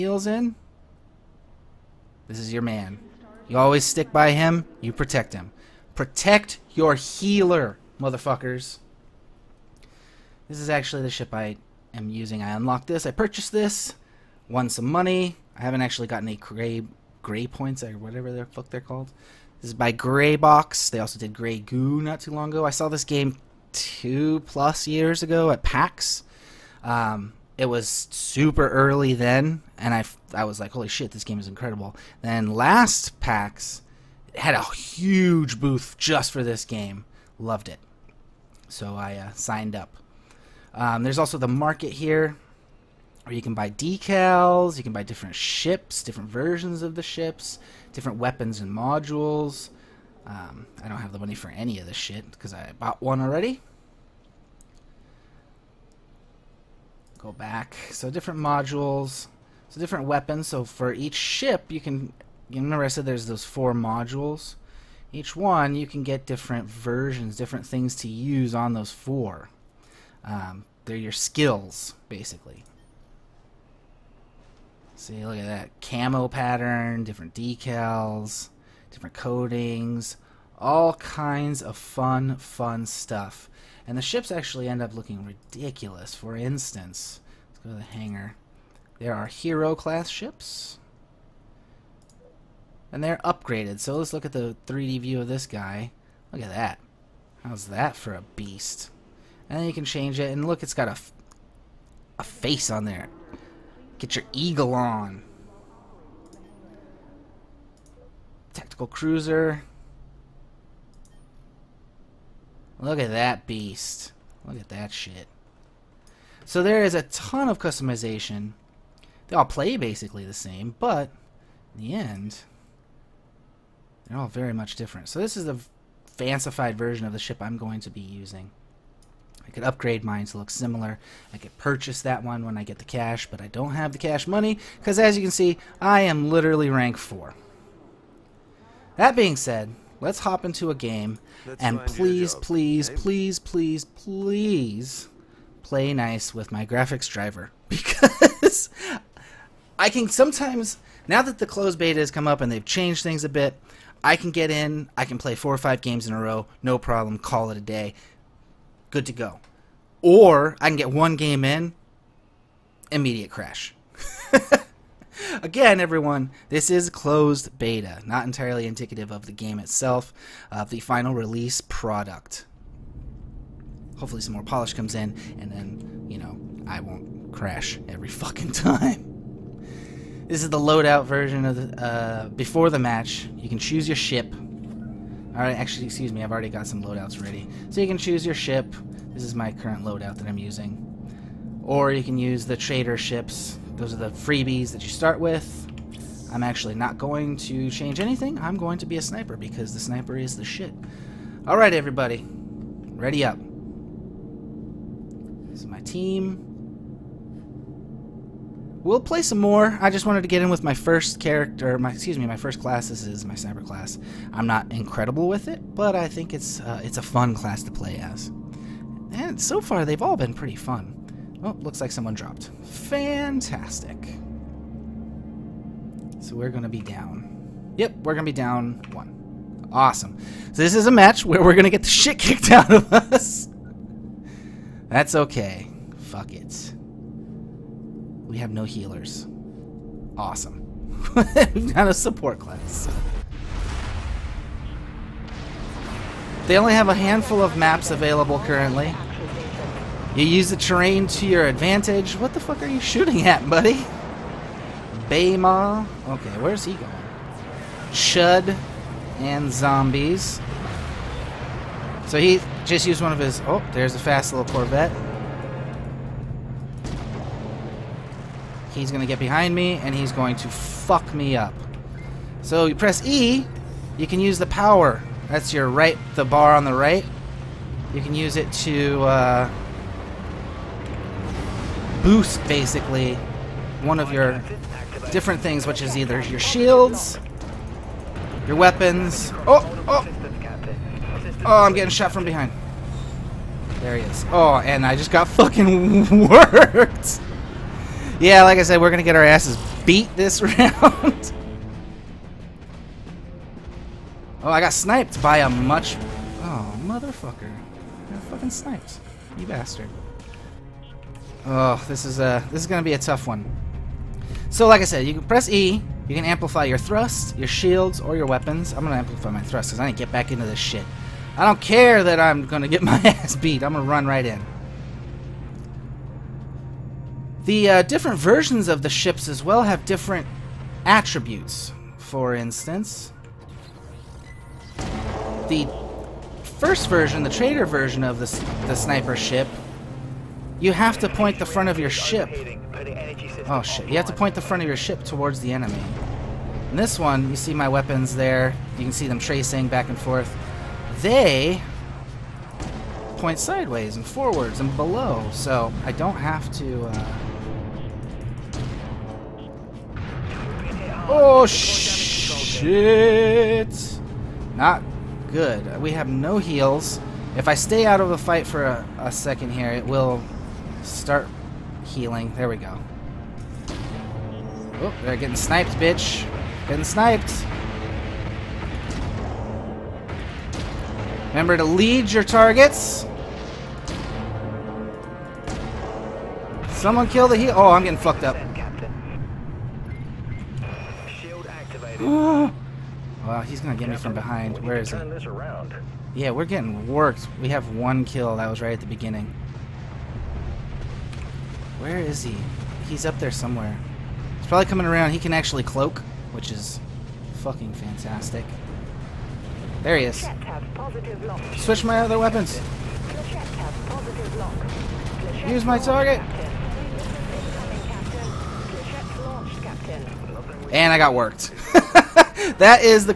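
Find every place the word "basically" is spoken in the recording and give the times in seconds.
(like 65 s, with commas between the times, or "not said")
72 s, 119 s, 282 s.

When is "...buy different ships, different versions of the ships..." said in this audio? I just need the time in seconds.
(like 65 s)
44 s.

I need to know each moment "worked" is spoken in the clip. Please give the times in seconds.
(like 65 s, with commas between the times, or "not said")
296 s, 396 s, 421 s.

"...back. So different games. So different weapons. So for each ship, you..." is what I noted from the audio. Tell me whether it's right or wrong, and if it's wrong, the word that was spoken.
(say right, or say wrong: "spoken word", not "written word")
wrong: "modules", not "games".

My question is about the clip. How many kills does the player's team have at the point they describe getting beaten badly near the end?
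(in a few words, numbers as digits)
1.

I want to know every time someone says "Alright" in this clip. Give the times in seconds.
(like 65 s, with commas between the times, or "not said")
184 s, 201 s.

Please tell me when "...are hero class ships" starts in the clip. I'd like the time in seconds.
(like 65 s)
89 s.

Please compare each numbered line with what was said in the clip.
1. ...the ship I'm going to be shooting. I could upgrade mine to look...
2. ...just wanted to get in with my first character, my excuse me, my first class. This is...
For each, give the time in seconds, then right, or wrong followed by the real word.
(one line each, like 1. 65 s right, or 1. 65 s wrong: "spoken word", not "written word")
1. 127 s wrong: "using", not "shooting"
2. 209 s right.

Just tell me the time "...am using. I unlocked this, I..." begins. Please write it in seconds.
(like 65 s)
11 s.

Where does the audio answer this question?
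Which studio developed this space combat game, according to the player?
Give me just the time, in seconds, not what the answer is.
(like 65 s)
19 s.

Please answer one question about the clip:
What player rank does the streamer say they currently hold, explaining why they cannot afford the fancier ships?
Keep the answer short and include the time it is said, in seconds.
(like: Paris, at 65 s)
4, at 136 s.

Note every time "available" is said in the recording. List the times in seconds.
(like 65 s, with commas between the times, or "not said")
247 s.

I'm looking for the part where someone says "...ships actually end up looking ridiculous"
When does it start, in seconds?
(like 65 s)
84 s.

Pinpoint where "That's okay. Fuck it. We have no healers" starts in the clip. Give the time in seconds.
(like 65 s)
234 s.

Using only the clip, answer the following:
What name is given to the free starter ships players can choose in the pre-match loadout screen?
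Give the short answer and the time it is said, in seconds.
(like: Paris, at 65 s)
trader ships, at 192 s.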